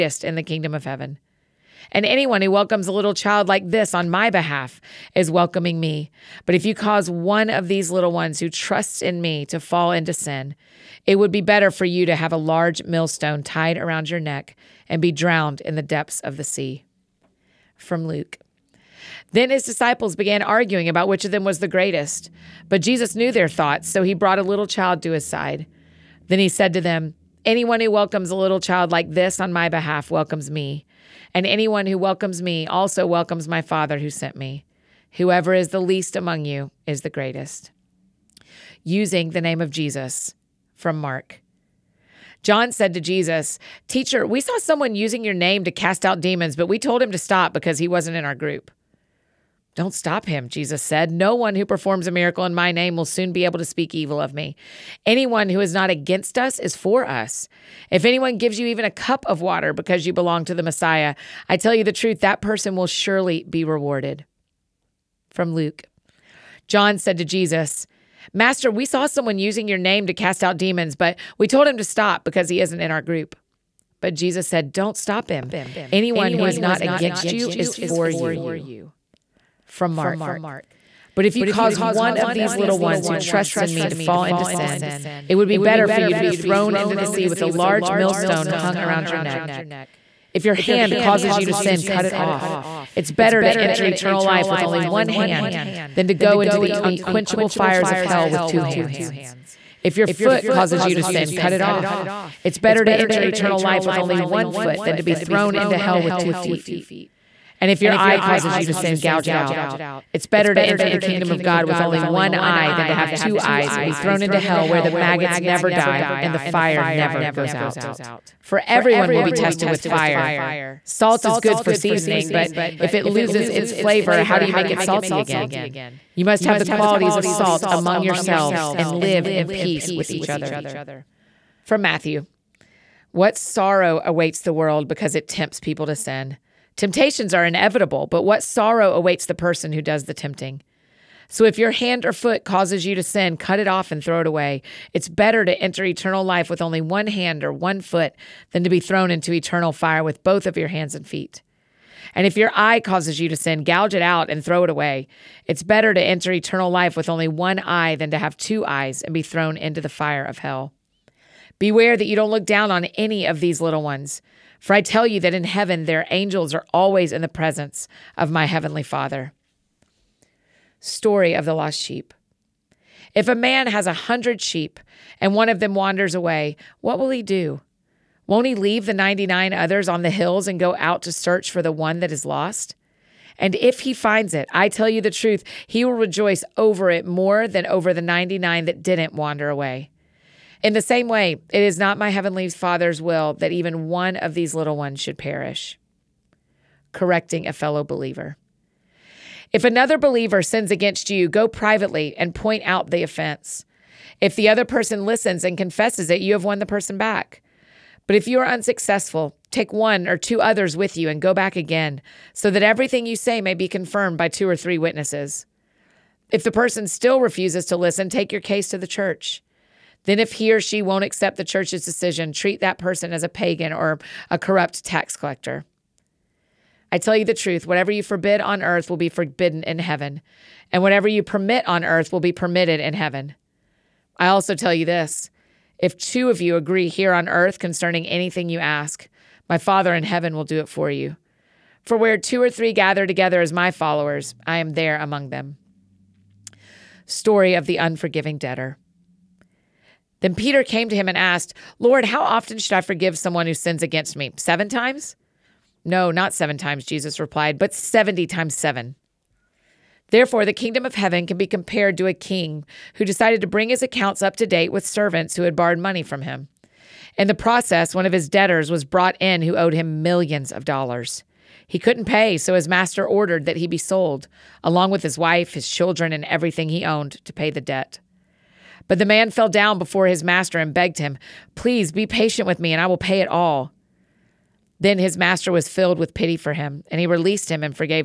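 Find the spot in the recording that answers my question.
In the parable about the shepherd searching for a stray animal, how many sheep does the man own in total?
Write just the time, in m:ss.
2:53.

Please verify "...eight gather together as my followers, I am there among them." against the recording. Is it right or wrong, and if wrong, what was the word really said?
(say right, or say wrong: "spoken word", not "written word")
wrong: "three", not "eight".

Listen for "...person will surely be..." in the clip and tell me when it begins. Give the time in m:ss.
1:02.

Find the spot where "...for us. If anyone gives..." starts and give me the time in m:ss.
0:56.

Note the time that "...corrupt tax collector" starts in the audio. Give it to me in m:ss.
3:44.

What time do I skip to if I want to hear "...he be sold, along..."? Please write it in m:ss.
4:33.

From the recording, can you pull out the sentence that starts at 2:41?
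Beware that you don't look down on any of these little ones.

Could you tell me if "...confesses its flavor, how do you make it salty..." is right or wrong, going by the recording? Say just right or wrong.
wrong.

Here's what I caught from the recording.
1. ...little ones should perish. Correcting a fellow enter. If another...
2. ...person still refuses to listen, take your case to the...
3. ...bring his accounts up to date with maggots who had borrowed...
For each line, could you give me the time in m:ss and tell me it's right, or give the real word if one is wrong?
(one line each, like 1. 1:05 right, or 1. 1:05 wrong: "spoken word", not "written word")
1. 3:14 wrong: "believer", not "enter"
2. 3:36 right
3. 4:23 wrong: "servants", not "maggots".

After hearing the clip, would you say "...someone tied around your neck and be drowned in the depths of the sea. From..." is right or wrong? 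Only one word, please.
wrong.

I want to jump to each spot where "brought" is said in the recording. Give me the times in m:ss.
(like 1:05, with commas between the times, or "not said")
0:24, 4:28.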